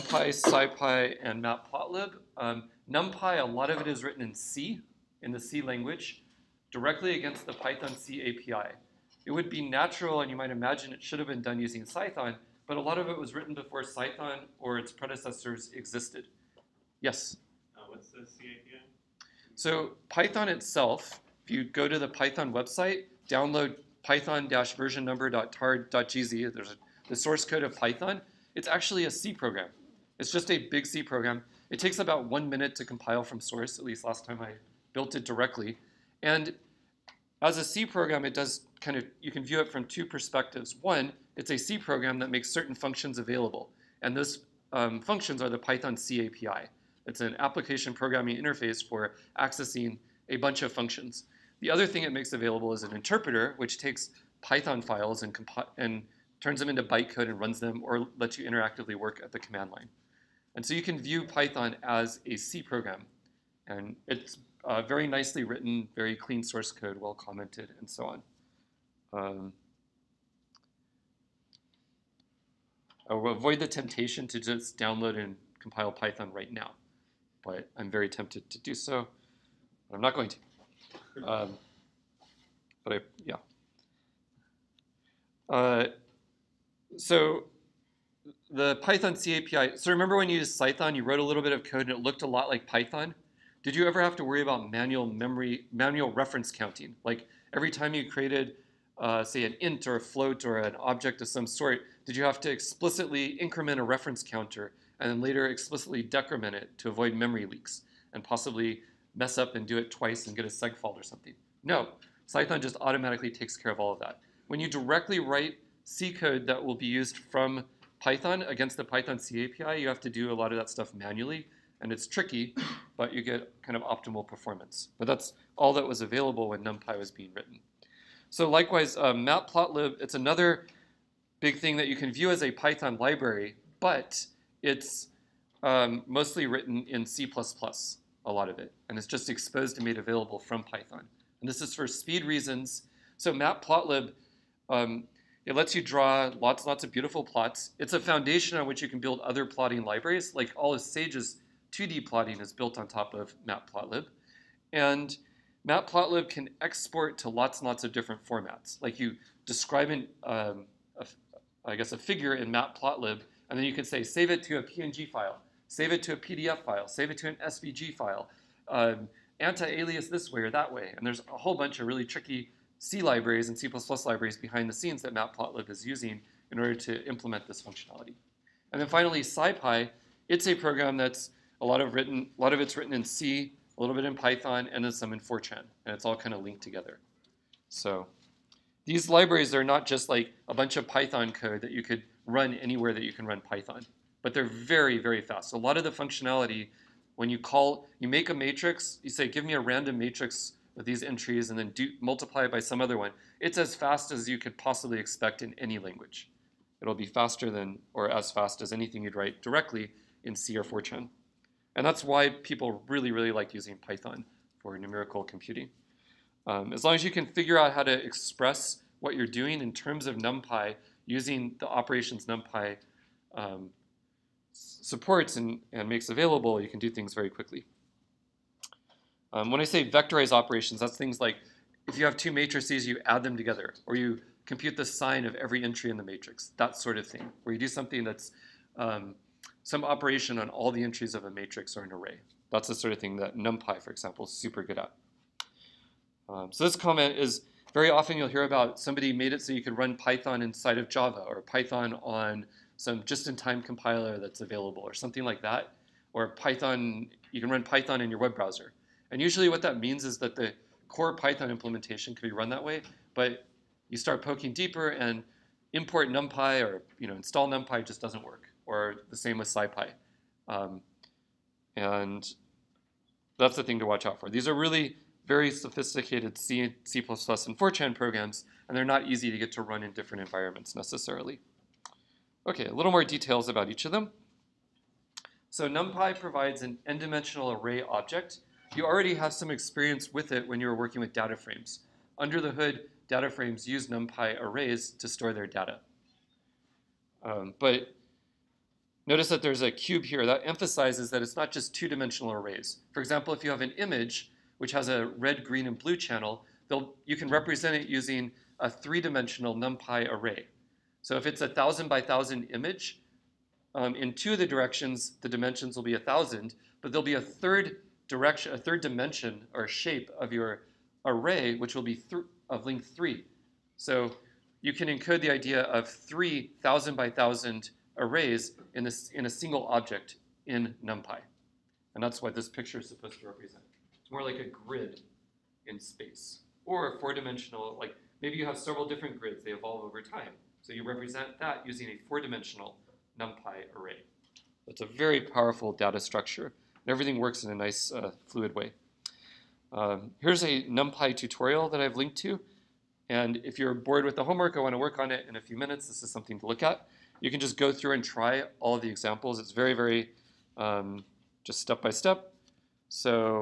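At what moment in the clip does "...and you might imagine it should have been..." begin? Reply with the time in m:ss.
0:10.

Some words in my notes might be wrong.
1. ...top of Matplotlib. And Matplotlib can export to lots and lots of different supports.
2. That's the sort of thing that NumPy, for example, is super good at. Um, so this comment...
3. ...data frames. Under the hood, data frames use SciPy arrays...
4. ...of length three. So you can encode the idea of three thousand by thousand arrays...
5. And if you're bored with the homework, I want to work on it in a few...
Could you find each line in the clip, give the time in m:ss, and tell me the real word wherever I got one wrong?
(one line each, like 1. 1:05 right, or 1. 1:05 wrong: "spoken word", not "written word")
1. 2:32 wrong: "formats", not "supports"
2. 4:02 right
3. 4:51 wrong: "NumPy", not "SciPy"
4. 5:22 right
5. 5:53 right.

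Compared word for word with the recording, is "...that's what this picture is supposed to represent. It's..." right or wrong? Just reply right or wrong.
right.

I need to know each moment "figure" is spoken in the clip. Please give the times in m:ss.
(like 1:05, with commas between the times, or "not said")
2:41, 3:37.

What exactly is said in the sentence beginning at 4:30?
Um, and that's the thing to watch out for.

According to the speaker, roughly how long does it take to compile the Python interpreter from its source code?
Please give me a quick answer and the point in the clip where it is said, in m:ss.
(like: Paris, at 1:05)
1 minute, at 0:31.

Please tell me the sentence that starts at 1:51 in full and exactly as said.
No, Cython just automatically takes care of all of that.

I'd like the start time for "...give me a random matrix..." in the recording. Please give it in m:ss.
3:19.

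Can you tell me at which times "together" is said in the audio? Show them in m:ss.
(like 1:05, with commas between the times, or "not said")
3:06, 3:53.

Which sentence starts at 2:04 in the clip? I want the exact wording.
But that's all that was available when NumPy was being written.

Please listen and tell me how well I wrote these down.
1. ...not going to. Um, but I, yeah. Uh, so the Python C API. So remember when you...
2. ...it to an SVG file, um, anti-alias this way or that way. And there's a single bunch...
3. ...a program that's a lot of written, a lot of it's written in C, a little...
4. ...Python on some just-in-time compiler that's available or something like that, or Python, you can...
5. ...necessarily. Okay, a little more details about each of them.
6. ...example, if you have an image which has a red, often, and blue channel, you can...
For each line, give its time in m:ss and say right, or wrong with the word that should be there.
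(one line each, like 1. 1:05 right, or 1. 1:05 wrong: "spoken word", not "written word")
1. 1:20 right
2. 2:47 wrong: "whole", not "single"
3. 3:00 right
4. 4:11 right
5. 4:40 right
6. 5:02 wrong: "green", not "often".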